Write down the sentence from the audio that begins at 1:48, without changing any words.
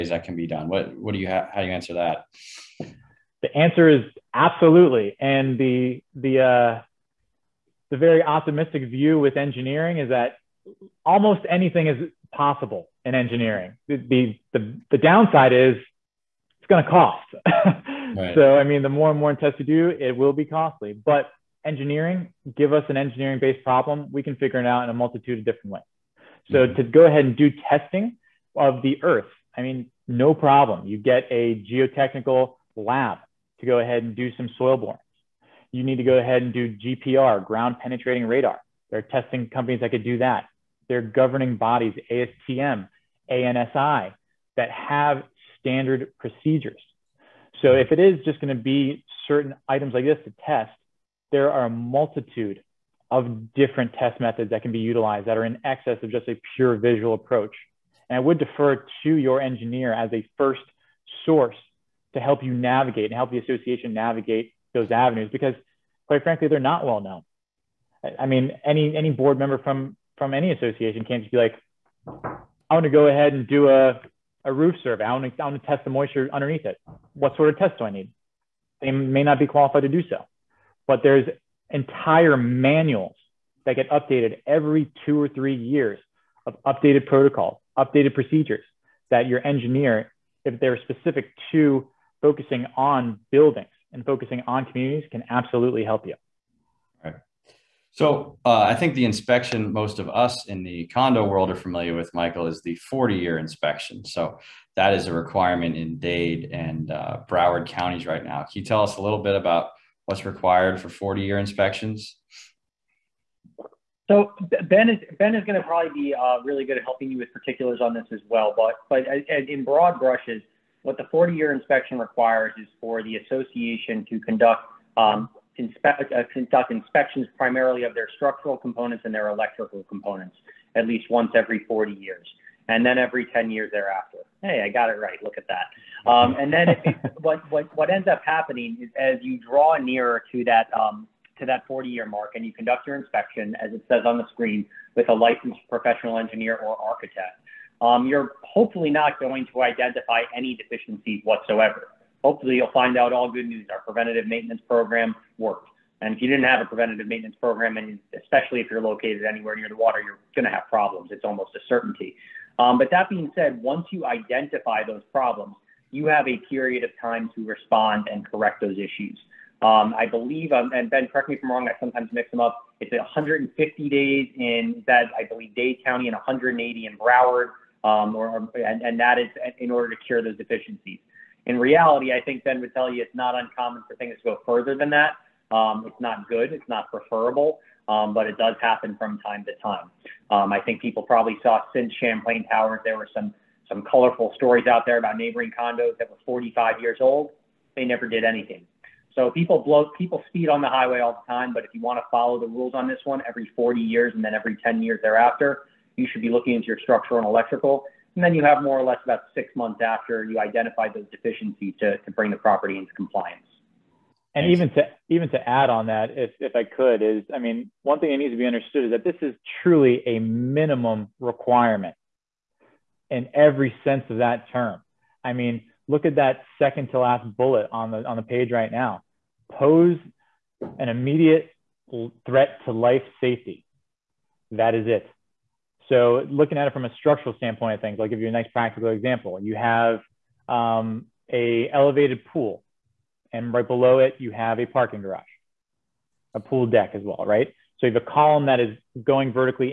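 Can you tell us a little bit about what's required for 40-year inspections?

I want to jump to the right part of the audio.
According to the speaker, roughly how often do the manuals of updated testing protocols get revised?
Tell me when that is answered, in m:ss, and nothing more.
1:24.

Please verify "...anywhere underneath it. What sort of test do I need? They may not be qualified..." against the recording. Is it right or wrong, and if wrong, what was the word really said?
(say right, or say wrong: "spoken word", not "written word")
wrong: "moisture", not "anywhere".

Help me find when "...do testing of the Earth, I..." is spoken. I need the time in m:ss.
0:27.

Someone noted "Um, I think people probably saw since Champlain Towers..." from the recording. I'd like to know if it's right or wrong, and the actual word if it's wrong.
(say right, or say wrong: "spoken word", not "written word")
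right.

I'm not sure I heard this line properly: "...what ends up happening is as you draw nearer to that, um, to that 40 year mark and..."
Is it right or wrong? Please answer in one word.
right.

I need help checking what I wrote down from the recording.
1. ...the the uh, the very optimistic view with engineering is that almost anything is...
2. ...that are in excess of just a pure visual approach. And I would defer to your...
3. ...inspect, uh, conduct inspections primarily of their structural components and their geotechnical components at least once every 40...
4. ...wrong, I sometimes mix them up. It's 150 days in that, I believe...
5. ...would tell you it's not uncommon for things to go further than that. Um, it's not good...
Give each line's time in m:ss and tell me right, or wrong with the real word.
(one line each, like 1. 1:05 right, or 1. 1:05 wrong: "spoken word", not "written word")
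1. 0:05 right
2. 0:55 right
3. 2:05 wrong: "electrical", not "geotechnical"
4. 2:51 right
5. 3:02 right.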